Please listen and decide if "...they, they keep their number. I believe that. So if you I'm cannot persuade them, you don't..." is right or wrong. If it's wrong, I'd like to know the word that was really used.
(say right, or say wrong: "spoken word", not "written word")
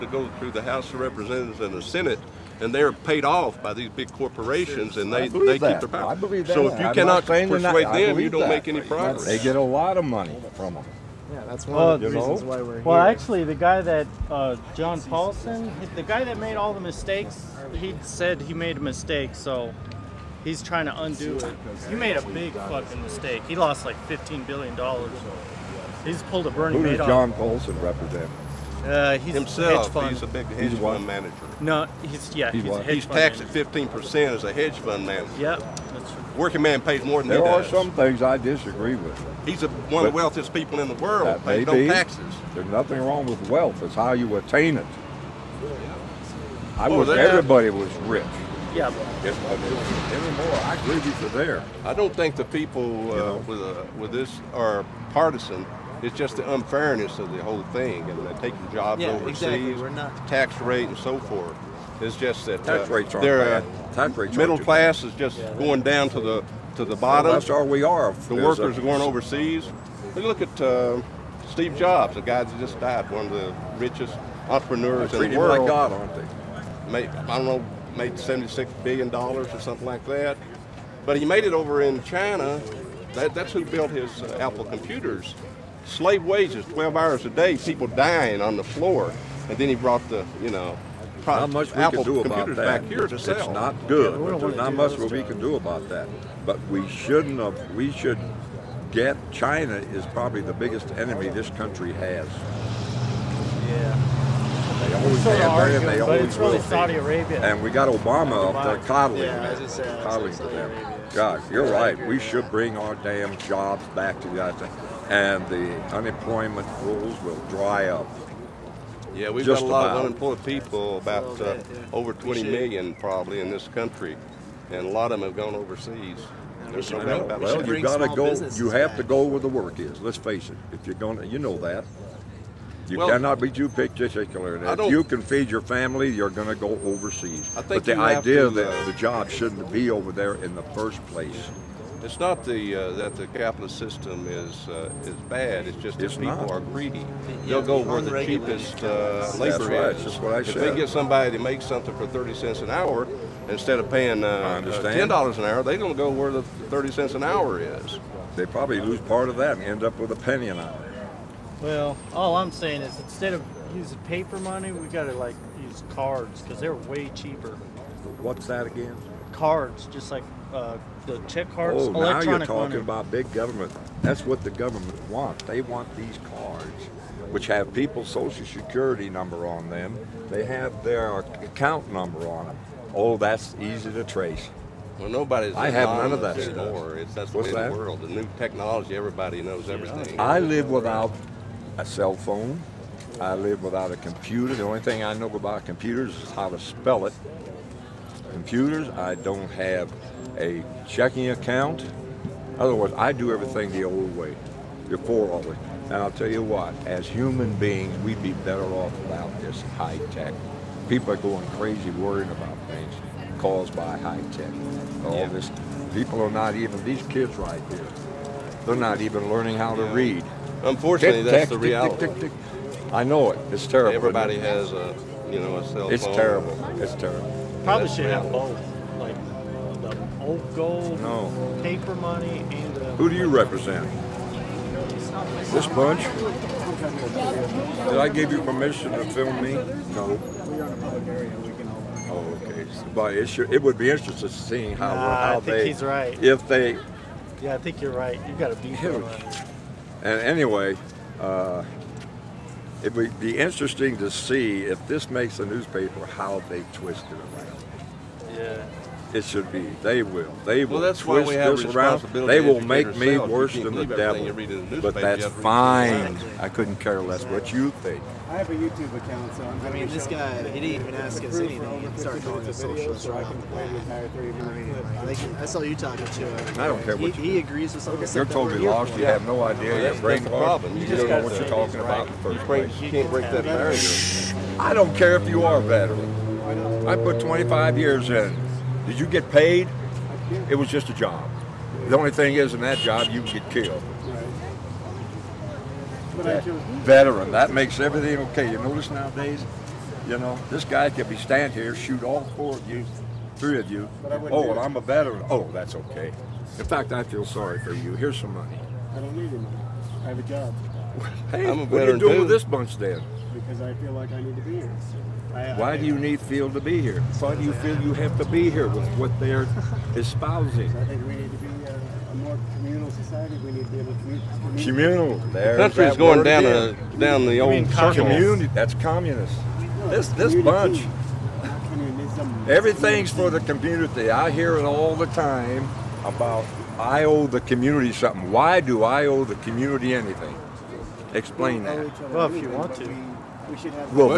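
wrong: "power", not "number".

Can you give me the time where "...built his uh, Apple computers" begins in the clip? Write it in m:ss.
1:23.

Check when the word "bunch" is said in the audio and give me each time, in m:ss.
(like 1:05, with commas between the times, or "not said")
3:55, 5:12, 5:30.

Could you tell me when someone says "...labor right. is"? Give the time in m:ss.
2:29.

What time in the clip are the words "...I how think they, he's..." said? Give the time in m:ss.
4:05.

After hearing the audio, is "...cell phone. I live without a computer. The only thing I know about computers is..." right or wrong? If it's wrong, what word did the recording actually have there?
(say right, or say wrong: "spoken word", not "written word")
right.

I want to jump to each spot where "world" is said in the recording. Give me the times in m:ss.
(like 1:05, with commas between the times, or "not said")
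0:40, 1:15, 3:07.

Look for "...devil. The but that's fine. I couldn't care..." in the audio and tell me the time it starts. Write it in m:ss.
4:23.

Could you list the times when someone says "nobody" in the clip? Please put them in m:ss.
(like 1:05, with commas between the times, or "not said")
3:05.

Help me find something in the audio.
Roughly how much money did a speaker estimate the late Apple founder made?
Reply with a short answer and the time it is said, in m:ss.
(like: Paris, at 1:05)
76 billion dollars, at 1:18.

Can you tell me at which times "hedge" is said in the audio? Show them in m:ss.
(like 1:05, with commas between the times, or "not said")
0:30, 0:34.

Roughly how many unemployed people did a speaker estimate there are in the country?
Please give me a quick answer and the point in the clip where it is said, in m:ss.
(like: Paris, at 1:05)
over 20 million, at 2:01.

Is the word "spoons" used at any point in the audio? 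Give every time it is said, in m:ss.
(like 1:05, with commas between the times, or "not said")
not said.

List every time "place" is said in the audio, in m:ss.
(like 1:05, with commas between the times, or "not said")
2:21, 4:42.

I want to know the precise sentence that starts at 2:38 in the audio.
They probably lose part of that and end up with a penny an hour.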